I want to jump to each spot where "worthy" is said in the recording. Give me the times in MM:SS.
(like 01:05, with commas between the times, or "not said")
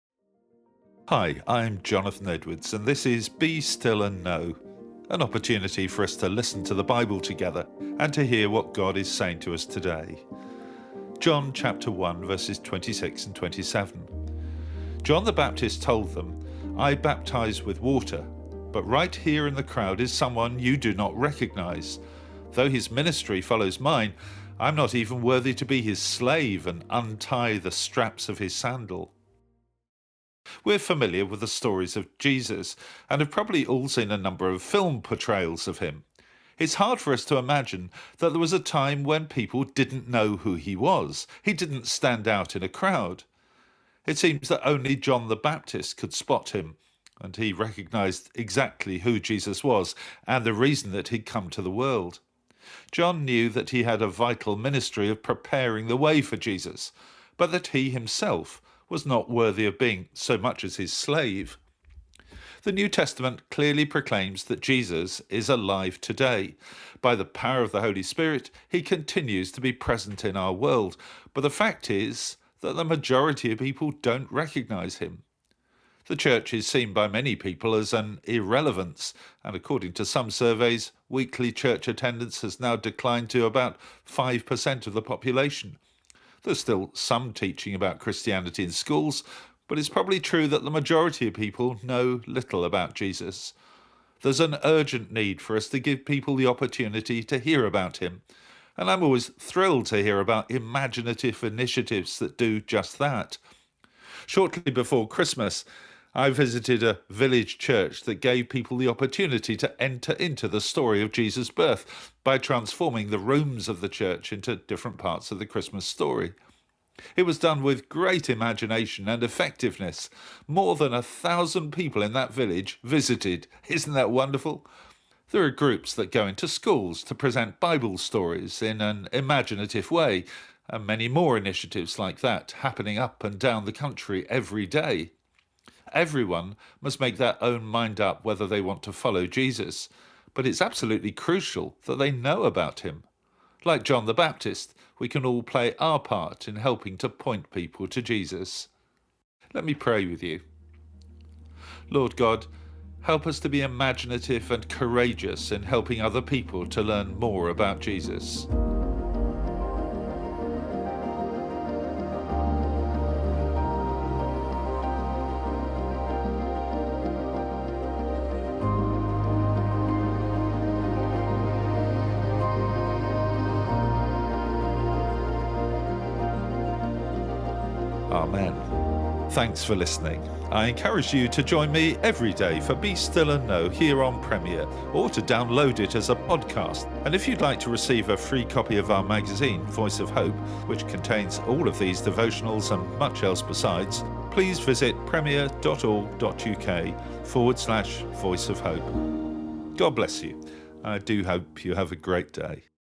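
00:25, 00:59.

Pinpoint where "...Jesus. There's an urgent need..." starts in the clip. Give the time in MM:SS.
01:32.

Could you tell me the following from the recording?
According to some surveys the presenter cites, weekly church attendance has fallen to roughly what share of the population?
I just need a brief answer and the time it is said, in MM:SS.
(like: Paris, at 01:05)
5%, at 01:23.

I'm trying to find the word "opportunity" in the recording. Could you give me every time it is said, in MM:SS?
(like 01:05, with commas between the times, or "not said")
00:05, 01:36, 01:48.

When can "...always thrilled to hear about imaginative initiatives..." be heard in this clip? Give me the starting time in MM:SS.
01:39.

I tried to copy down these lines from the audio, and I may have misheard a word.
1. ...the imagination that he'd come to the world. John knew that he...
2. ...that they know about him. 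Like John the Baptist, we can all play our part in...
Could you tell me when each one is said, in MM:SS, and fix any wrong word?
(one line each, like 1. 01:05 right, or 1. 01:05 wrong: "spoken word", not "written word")
1. 00:50 wrong: "reason", not "imagination"
2. 02:21 right.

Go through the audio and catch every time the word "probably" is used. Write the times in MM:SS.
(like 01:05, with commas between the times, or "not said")
00:33, 01:29.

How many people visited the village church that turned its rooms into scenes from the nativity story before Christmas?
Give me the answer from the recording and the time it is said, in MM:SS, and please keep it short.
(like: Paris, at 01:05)
More than 1,000, at 02:00.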